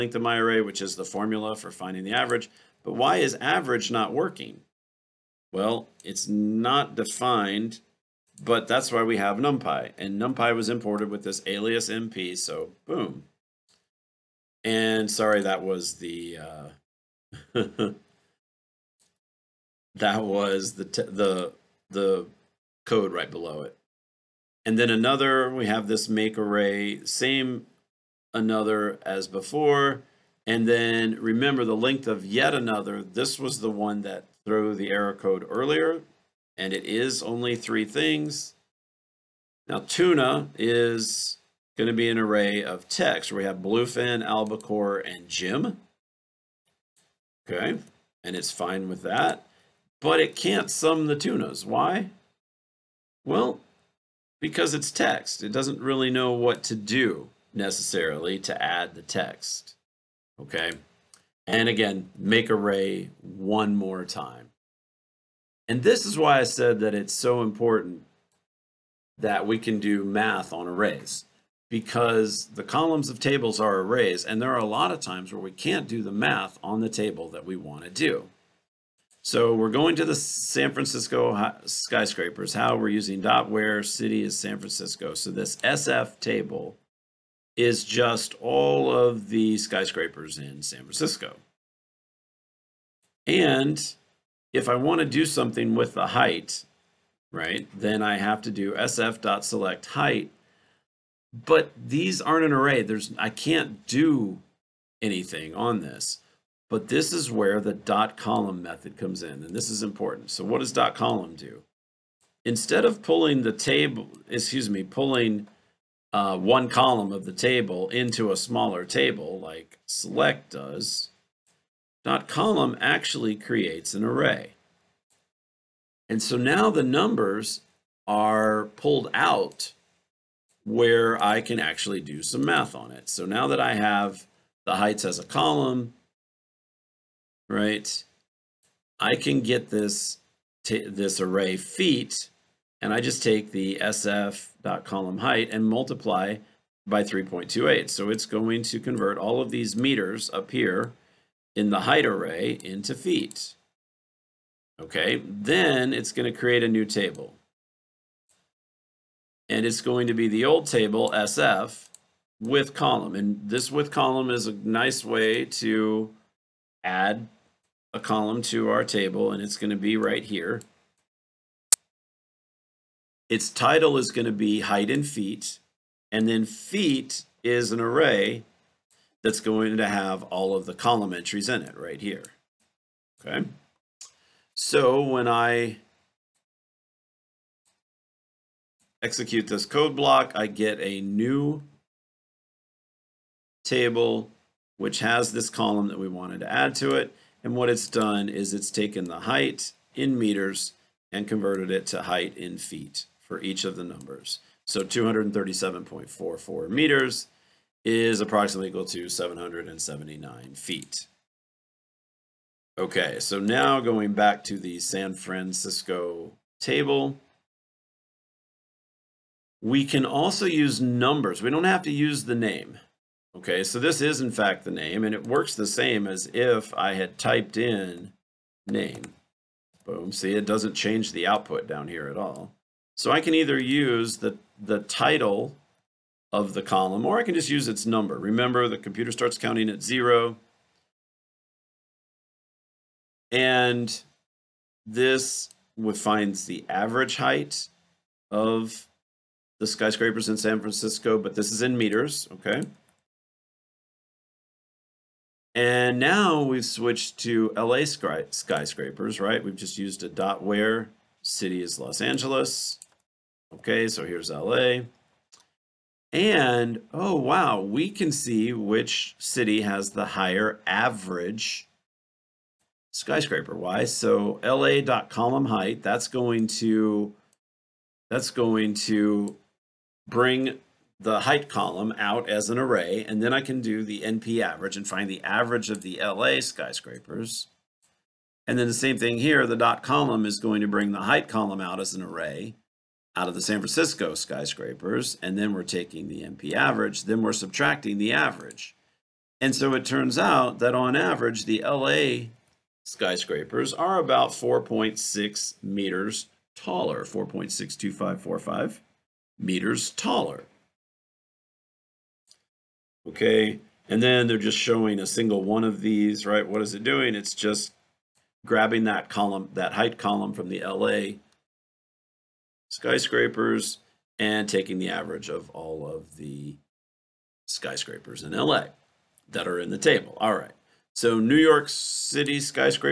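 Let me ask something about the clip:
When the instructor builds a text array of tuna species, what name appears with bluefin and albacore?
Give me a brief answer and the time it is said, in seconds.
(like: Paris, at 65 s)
Jim, at 45 s.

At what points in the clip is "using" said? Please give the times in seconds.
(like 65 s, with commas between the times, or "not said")
82 s.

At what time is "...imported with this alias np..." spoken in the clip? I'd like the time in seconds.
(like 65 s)
10 s.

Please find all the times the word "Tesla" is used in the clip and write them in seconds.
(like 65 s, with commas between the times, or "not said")
not said.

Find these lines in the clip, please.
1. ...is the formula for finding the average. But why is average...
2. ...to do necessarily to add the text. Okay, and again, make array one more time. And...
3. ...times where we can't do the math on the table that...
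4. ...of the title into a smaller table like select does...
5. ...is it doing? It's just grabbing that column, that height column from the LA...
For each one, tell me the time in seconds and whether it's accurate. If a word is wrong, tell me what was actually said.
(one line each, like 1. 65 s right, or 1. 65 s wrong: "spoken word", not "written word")
1. 0 s right
2. 56 s right
3. 74 s right
4. 117 s wrong: "table", not "title"
5. 316 s right.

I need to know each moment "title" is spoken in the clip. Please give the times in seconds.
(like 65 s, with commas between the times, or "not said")
173 s, 234 s.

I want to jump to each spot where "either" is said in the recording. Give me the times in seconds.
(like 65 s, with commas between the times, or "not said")
233 s.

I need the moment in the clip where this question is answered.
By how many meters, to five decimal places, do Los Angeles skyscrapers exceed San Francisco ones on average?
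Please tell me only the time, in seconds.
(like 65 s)
307 s.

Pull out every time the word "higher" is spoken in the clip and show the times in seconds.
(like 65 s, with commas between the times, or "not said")
270 s.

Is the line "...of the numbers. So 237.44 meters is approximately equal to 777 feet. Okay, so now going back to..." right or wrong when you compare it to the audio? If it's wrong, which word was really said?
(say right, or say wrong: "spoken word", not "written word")
wrong: "779", not "777".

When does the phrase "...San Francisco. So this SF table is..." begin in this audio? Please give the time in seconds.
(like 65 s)
84 s.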